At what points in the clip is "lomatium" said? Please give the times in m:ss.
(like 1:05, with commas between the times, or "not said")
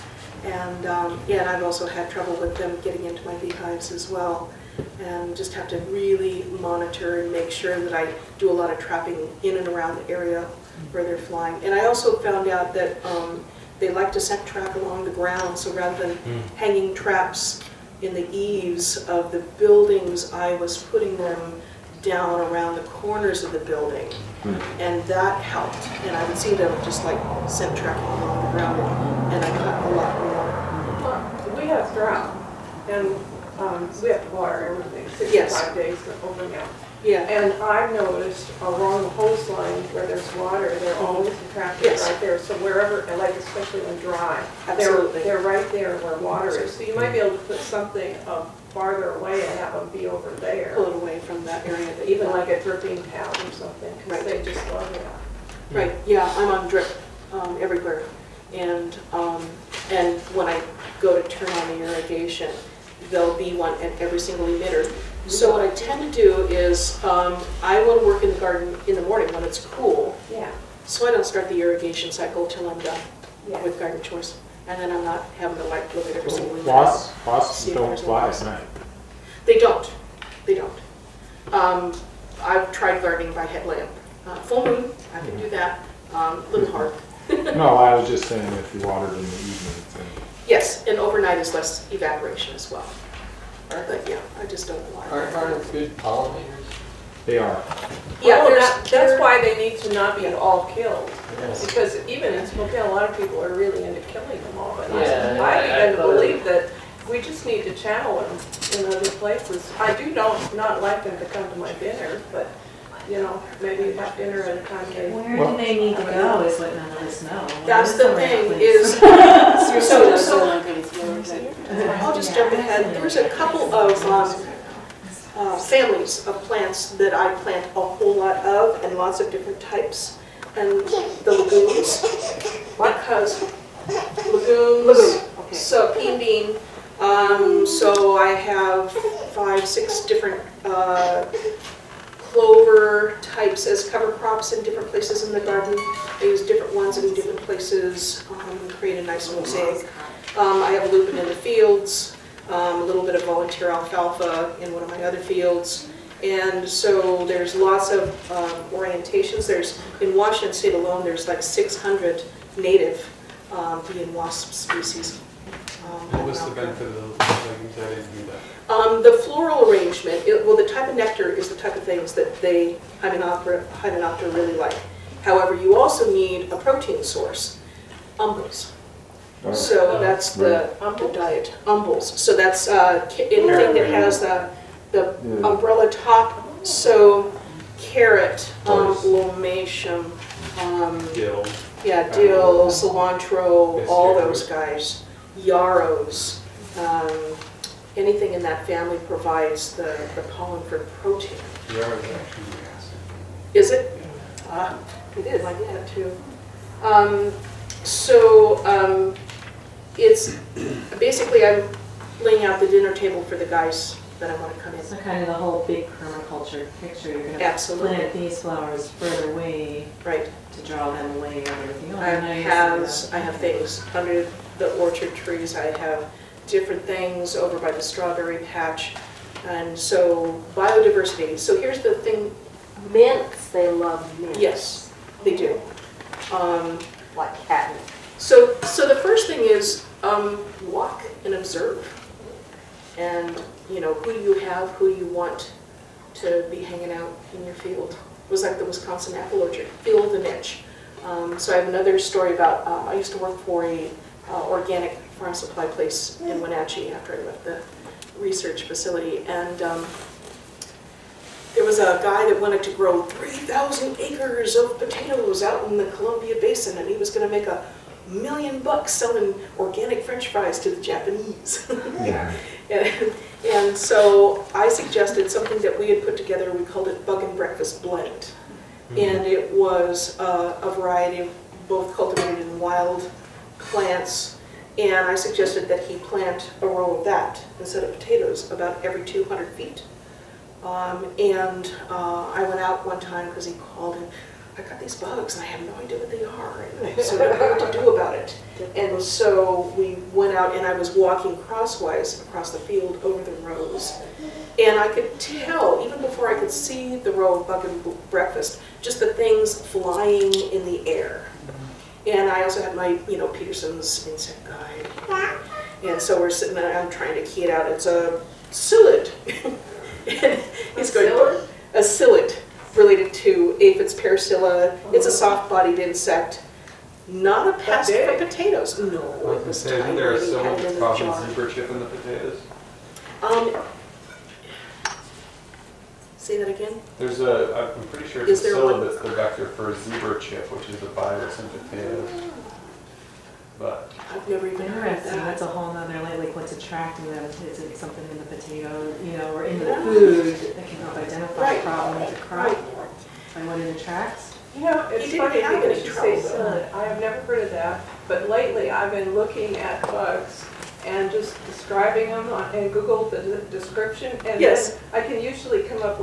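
3:09.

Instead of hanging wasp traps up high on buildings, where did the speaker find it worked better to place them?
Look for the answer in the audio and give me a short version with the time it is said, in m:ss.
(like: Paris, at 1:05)
Corners of the building, at 0:22.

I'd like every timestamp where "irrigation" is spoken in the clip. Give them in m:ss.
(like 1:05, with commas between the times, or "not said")
1:01, 1:11.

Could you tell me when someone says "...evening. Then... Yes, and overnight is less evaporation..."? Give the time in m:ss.
1:29.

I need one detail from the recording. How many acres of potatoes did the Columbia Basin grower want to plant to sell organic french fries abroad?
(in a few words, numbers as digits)
3,000.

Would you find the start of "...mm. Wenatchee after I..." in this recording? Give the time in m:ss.
4:16.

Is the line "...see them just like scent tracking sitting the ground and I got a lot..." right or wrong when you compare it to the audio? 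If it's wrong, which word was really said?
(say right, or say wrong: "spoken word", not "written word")
wrong: "along", not "sitting".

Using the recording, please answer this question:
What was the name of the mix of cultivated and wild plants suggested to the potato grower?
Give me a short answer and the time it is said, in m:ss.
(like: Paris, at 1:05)
Bug and Breakfast Blend, at 4:37.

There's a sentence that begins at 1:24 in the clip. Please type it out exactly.
Uh, full moon, I can do that.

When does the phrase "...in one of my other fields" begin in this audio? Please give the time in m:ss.
2:34.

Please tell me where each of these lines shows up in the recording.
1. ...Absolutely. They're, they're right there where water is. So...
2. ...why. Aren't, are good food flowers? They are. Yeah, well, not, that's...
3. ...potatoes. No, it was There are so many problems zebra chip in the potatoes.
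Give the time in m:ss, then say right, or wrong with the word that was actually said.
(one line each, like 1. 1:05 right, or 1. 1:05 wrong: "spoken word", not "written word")
1. 0:44 right
2. 1:34 wrong: "pollinators", not "flowers"
3. 5:28 right.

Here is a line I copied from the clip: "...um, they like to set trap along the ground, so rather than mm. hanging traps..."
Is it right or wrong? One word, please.
right.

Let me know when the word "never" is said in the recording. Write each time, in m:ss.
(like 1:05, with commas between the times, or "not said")
5:44, 5:56.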